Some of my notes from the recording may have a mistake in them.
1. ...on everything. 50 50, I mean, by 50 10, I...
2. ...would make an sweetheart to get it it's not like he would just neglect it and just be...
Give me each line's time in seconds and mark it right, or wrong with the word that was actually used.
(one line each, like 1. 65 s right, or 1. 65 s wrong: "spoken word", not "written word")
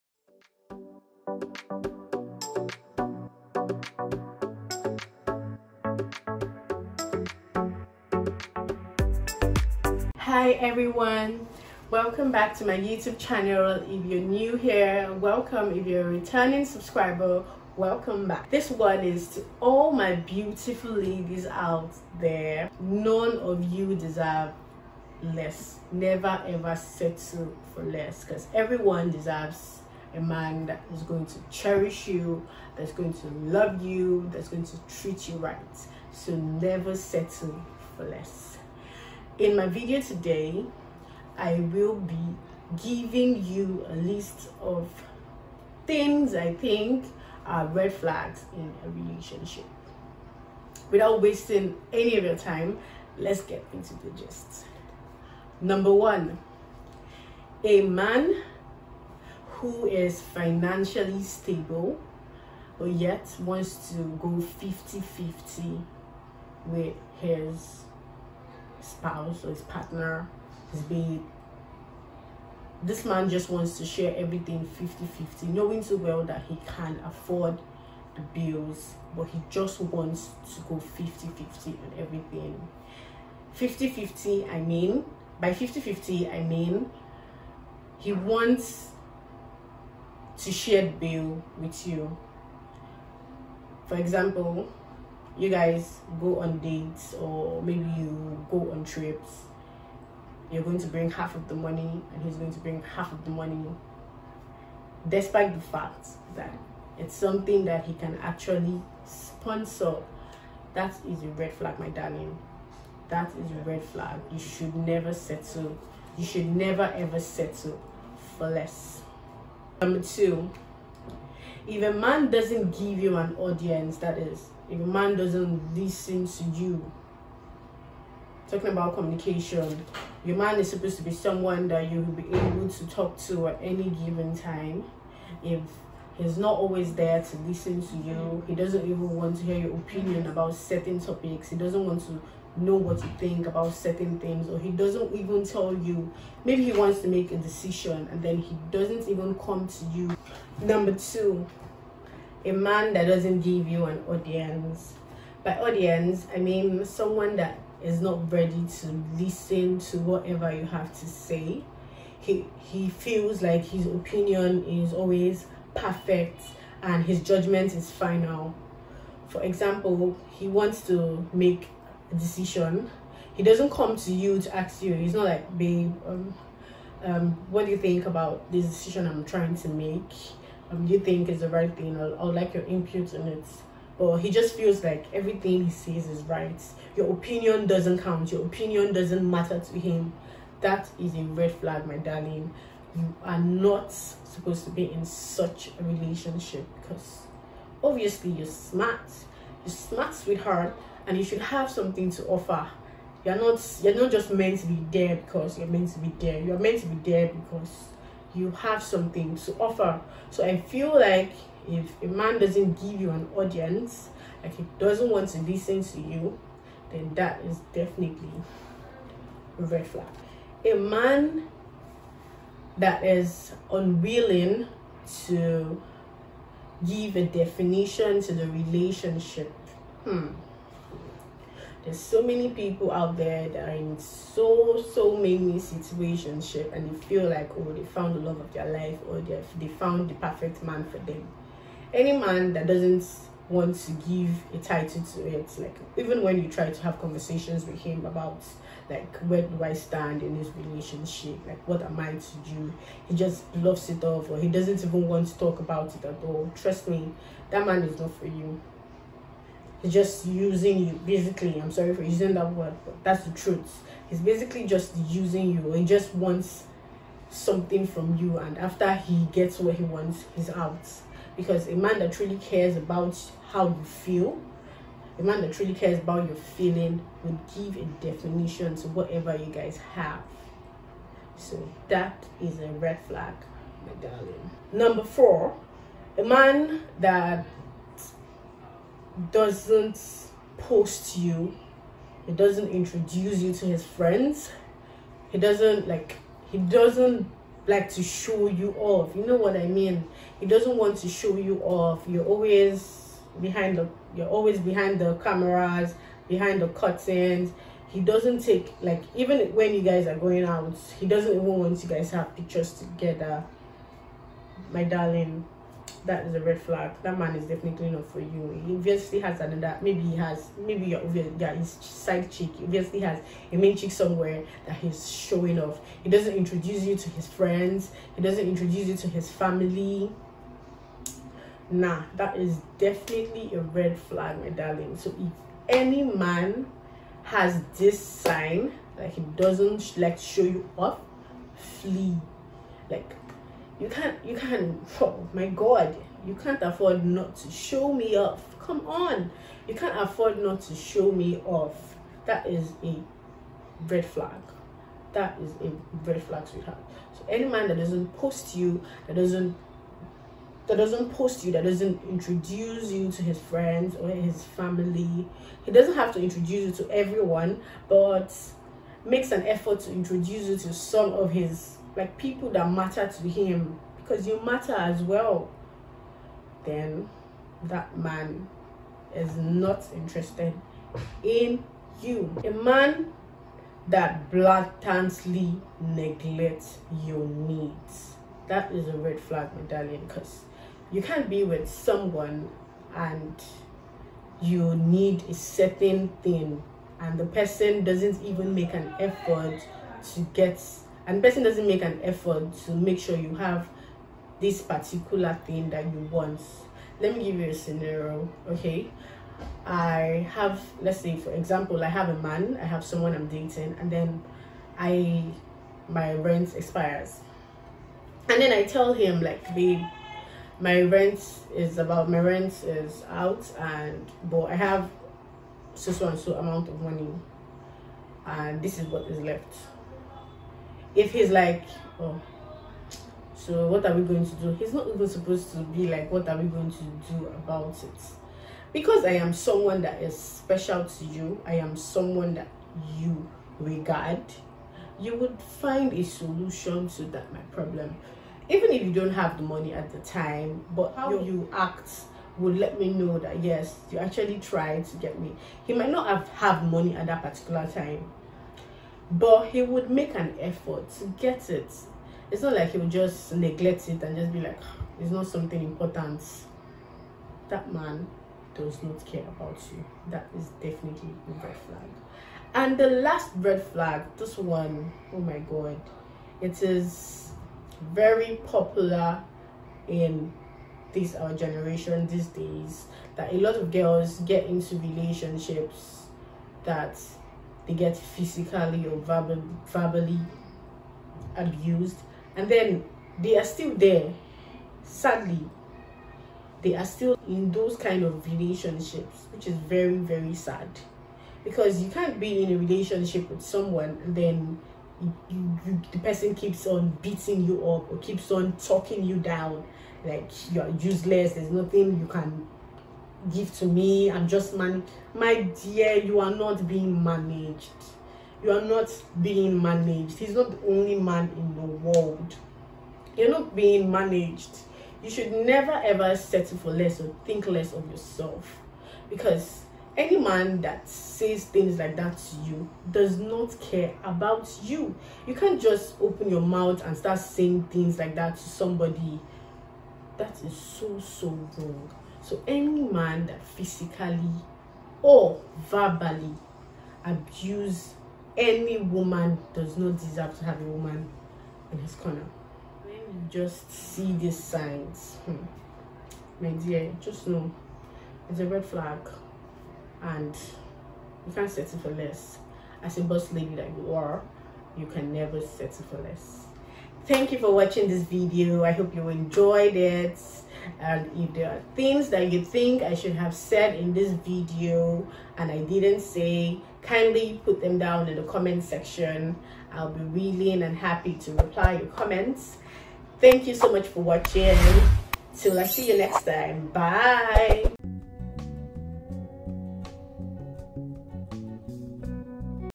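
1. 81 s wrong: "50", not "10"
2. 459 s wrong: "effort", not "sweetheart".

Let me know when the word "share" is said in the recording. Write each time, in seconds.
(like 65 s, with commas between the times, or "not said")
73 s, 90 s.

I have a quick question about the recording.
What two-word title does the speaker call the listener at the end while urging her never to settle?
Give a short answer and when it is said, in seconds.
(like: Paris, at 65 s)
boss lady, at 563 s.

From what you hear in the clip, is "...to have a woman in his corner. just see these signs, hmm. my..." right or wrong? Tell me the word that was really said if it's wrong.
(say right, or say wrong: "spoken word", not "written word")
right.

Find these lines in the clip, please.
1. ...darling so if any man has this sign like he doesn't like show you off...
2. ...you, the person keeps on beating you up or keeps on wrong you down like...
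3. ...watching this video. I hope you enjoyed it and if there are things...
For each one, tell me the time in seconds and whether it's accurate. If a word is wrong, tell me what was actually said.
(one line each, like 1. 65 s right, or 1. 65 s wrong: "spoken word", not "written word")
1. 334 s right
2. 505 s wrong: "talking", not "wrong"
3. 567 s right.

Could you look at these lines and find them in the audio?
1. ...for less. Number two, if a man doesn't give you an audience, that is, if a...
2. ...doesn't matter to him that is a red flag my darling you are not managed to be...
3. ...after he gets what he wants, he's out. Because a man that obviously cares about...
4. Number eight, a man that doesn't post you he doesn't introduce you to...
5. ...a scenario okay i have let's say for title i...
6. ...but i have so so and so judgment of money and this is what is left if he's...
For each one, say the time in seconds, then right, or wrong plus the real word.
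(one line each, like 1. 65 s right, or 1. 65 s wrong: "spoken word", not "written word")
1. 118 s right
2. 188 s wrong: "supposed", not "managed"
3. 268 s wrong: "truly", not "obviously"
4. 284 s wrong: "four", not "eight"
5. 407 s wrong: "example", not "title"
6. 424 s wrong: "amount", not "judgment".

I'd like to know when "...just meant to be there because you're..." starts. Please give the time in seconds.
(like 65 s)
204 s.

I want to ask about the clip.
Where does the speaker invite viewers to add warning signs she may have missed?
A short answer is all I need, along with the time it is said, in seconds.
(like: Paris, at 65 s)
comment section, at 578 s.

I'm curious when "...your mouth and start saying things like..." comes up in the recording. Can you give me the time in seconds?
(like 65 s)
536 s.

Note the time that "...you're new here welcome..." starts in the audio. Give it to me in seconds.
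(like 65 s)
14 s.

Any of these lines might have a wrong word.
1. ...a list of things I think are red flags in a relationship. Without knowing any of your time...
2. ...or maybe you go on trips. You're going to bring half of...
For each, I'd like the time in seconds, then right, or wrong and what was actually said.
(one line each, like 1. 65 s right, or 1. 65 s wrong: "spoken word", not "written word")
1. 43 s wrong: "wasting", not "knowing"
2. 97 s right.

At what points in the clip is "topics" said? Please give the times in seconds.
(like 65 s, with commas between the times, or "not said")
140 s.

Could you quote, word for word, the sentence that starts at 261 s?
I'm sorry for using that word, but that's the truth.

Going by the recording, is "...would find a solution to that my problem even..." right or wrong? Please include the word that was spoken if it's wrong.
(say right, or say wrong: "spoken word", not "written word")
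right.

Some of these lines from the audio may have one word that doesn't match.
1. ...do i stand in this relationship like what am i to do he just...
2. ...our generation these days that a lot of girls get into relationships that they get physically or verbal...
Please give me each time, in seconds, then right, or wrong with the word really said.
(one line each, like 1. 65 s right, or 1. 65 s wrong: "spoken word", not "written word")
1. 249 s right
2. 481 s right.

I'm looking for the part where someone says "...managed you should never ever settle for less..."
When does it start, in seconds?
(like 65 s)
523 s.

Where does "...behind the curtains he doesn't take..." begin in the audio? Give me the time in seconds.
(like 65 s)
306 s.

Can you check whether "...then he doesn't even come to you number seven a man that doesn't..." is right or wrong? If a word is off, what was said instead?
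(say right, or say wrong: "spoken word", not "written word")
wrong: "two", not "seven".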